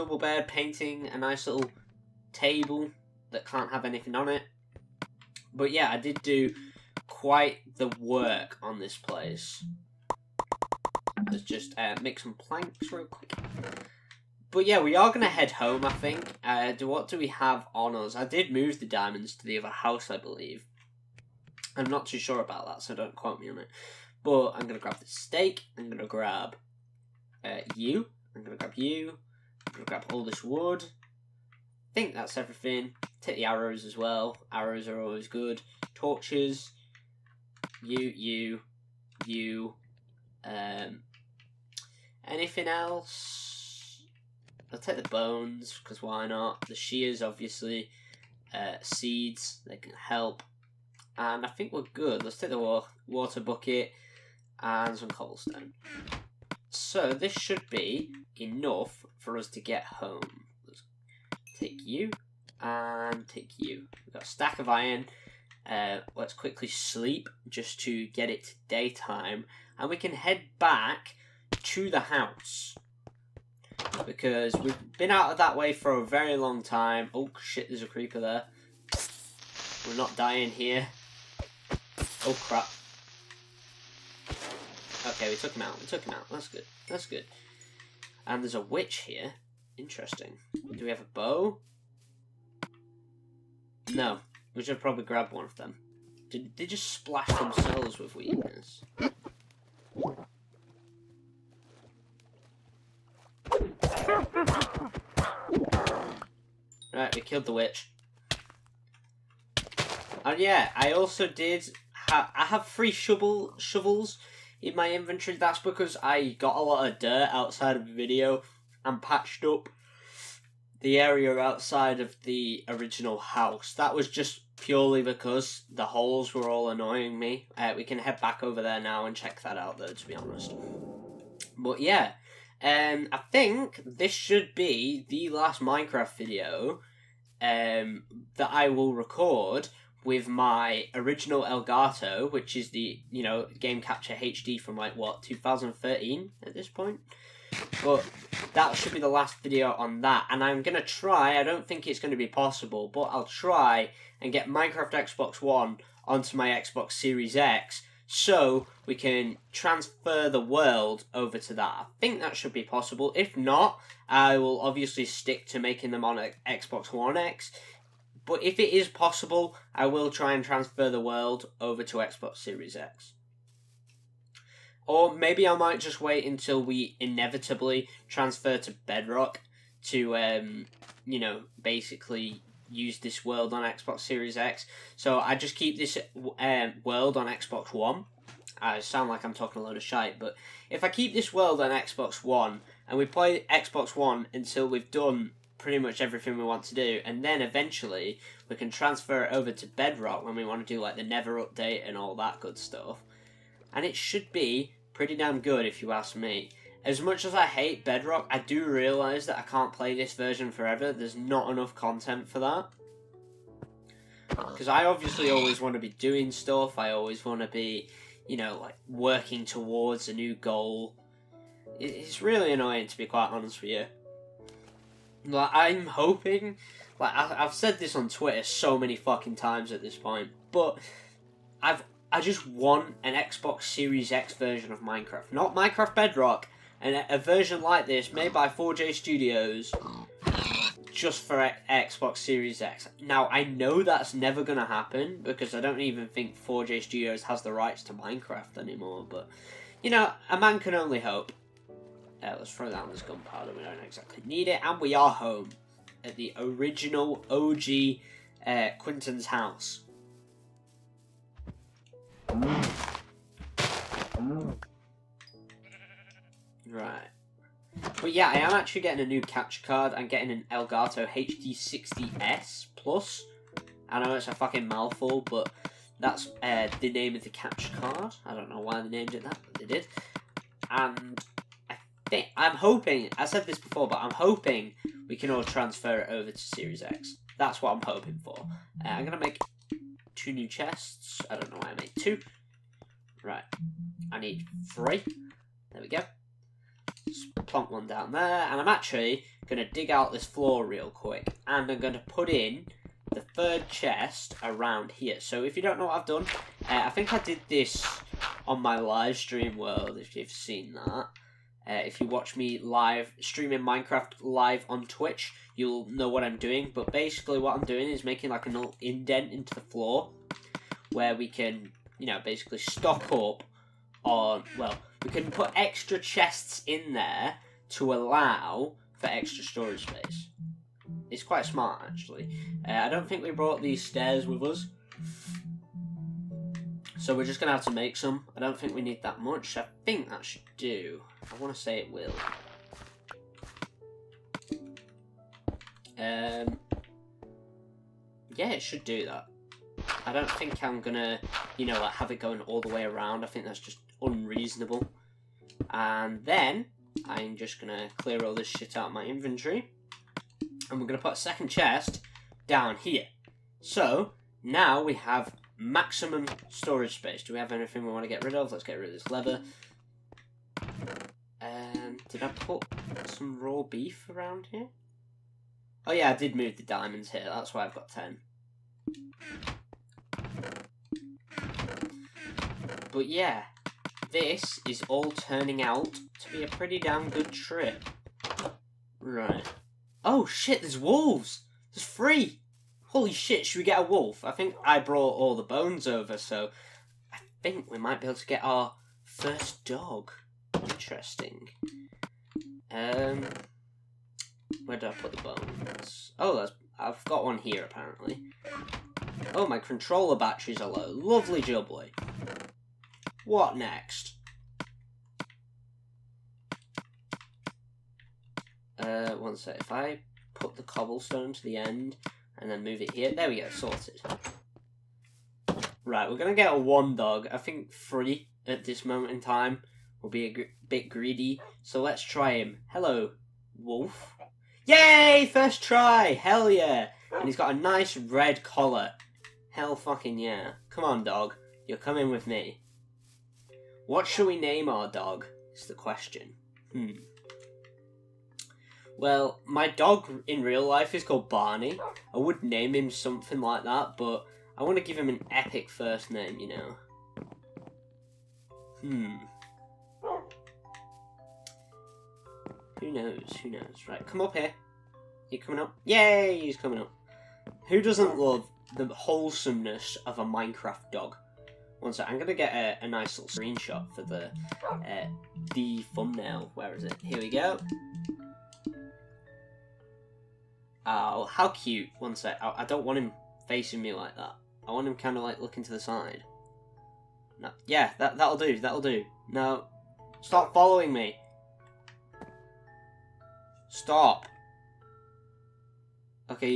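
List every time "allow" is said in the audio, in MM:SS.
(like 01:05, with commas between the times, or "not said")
05:27.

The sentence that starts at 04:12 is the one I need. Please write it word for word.
Uh, let's throw that on this gunpowder.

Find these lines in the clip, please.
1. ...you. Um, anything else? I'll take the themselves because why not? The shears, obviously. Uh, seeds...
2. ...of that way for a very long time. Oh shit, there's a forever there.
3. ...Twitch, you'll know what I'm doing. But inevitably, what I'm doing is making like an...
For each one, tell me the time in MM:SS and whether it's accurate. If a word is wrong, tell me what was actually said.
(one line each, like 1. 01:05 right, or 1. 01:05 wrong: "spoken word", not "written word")
1. 00:39 wrong: "bones", not "themselves"
2. 01:15 wrong: "creeper", not "forever"
3. 05:14 wrong: "basically", not "inevitably".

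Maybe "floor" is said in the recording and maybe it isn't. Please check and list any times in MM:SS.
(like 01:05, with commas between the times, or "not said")
05:00, 05:19.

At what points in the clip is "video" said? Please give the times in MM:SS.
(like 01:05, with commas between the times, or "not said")
01:57, 02:16, 02:29.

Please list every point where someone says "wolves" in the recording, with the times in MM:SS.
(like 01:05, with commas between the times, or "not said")
06:30.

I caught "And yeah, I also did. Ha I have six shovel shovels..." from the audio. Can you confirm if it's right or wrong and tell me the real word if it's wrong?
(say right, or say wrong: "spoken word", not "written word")
wrong: "three", not "six".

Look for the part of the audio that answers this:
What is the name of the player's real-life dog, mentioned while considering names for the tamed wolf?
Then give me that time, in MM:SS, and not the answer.
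07:31.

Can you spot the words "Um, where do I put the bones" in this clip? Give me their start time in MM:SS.
06:42.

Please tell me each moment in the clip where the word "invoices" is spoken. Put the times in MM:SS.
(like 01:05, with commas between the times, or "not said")
not said.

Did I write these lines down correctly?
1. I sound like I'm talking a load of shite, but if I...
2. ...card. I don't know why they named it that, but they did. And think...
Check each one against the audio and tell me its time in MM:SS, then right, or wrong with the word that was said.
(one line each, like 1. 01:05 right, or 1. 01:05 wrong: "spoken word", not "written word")
1. 03:08 right
2. 04:37 right.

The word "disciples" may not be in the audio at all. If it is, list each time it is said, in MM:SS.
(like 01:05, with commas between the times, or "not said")
not said.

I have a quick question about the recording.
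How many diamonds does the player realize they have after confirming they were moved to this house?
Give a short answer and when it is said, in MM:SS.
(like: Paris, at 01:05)
10, at 06:17.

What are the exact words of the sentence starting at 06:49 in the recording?
Oh, my controller batteries are low.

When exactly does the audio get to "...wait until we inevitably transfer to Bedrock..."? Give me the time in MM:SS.
02:55.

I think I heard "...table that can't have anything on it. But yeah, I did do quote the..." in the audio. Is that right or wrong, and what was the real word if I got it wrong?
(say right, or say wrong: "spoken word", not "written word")
wrong: "quite", not "quote".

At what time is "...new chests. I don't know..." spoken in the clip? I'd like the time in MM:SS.
04:50.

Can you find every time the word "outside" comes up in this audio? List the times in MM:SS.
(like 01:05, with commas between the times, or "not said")
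01:57, 02:01.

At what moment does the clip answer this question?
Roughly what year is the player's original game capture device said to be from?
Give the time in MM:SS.
02:25.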